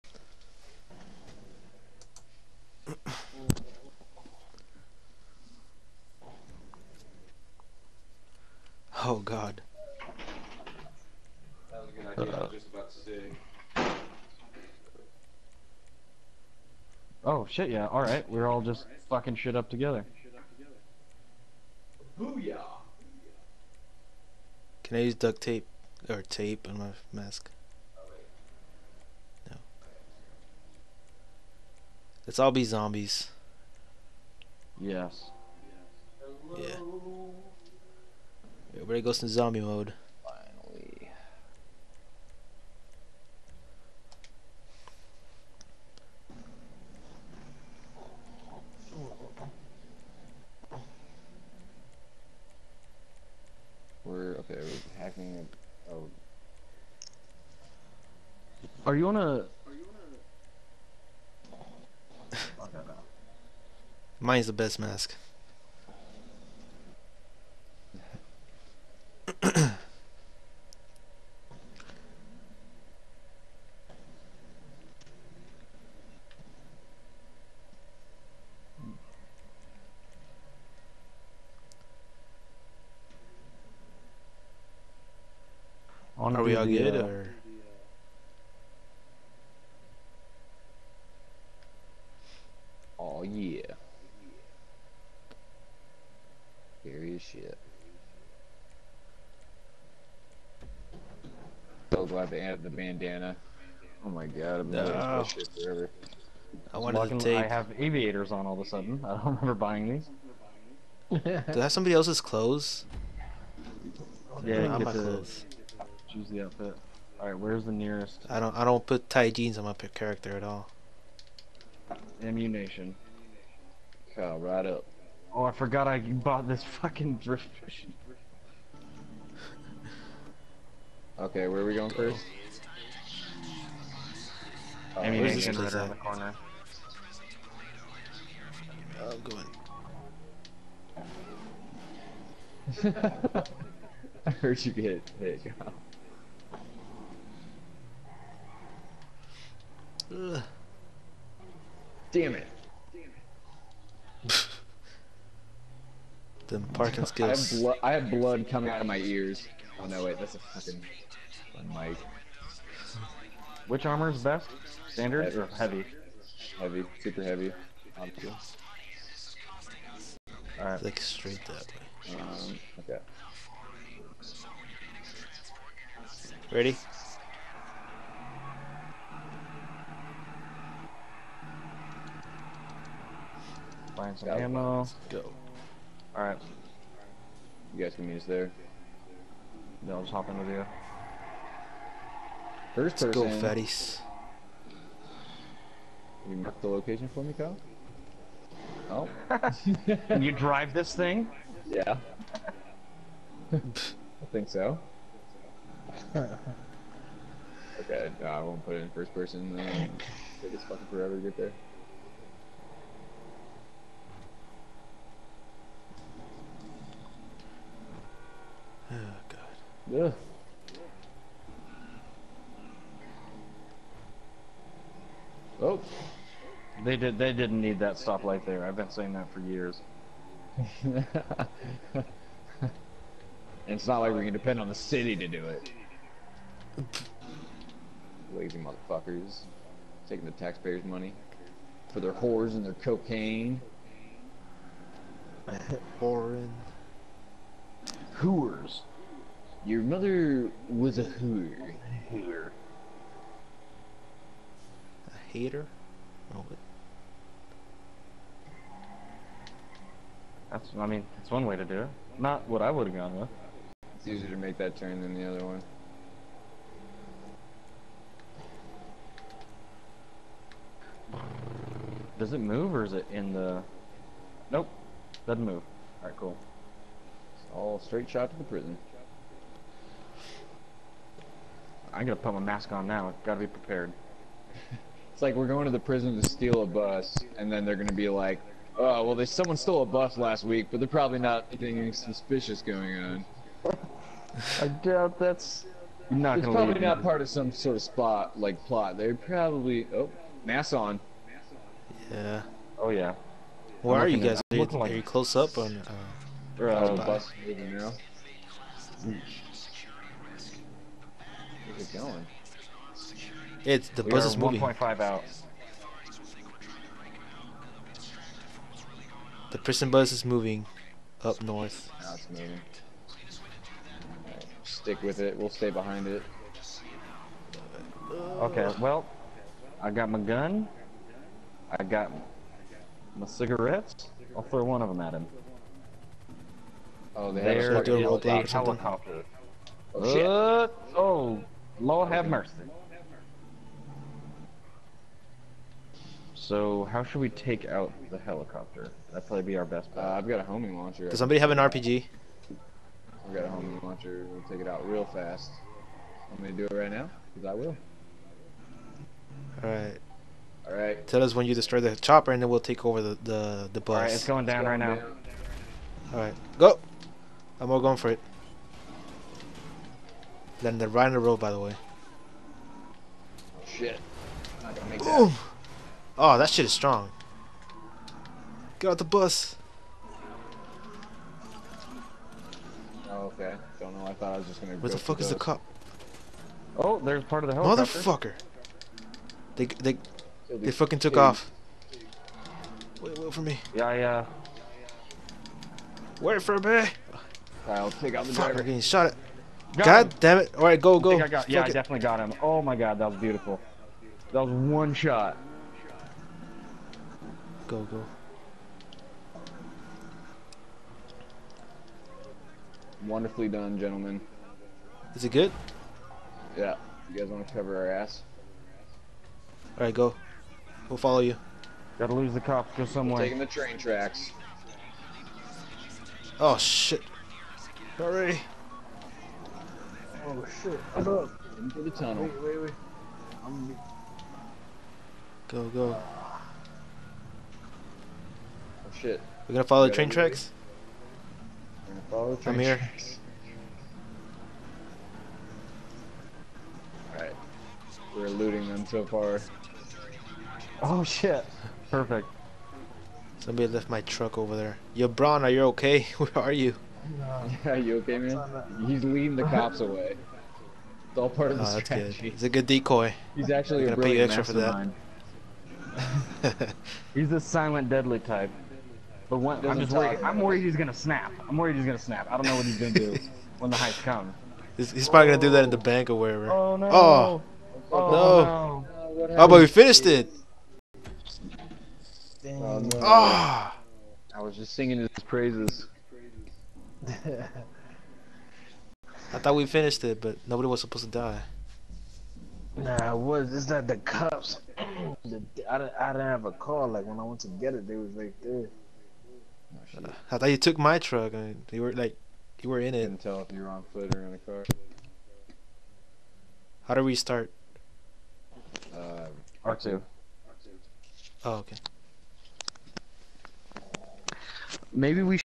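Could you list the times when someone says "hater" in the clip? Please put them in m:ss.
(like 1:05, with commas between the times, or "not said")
4:15.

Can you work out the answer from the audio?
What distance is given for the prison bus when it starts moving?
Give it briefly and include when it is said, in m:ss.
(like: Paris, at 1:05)
1.5, at 5:14.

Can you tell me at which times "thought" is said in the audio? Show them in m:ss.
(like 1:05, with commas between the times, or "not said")
6:24, 8:09, 8:20.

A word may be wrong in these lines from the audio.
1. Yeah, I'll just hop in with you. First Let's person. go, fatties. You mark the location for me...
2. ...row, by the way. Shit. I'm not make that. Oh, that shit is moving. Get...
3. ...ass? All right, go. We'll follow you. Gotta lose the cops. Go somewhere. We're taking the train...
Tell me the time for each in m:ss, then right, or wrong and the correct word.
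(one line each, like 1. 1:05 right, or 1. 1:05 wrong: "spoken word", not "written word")
1. 3:09 right
2. 6:11 wrong: "strong", not "moving"
3. 6:57 right.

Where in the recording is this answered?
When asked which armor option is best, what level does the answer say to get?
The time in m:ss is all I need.
2:47.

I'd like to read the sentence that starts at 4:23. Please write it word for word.
It's easier to make that turn than the other one.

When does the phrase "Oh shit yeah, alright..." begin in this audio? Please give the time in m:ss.
0:17.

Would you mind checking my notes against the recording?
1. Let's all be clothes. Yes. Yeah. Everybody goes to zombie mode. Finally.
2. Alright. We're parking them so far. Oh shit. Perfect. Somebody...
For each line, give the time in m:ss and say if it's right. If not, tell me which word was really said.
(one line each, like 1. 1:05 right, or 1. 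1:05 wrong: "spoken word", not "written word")
1. 0:32 wrong: "zombies", not "clothes"
2. 7:27 wrong: "looting", not "parking".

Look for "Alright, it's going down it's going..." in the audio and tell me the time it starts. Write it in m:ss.
6:03.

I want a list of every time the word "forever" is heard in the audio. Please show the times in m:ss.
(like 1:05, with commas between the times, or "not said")
1:45, 3:30.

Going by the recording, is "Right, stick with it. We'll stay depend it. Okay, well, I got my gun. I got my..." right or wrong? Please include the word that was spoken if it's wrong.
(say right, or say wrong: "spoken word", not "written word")
wrong: "behind", not "depend".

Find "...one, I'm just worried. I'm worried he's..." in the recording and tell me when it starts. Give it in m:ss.
7:49.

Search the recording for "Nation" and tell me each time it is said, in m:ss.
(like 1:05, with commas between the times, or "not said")
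2:02, 2:15.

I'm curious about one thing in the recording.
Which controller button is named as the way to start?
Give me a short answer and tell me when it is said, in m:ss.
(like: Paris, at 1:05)
R2, at 8:29.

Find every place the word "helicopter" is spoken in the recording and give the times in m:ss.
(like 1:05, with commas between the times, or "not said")
5:38, 5:48, 6:27.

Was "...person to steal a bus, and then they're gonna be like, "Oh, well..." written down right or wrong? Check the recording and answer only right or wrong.
wrong.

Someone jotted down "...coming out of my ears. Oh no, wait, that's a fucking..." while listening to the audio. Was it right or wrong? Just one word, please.
right.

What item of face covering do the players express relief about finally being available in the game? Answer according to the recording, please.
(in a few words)
Bandana.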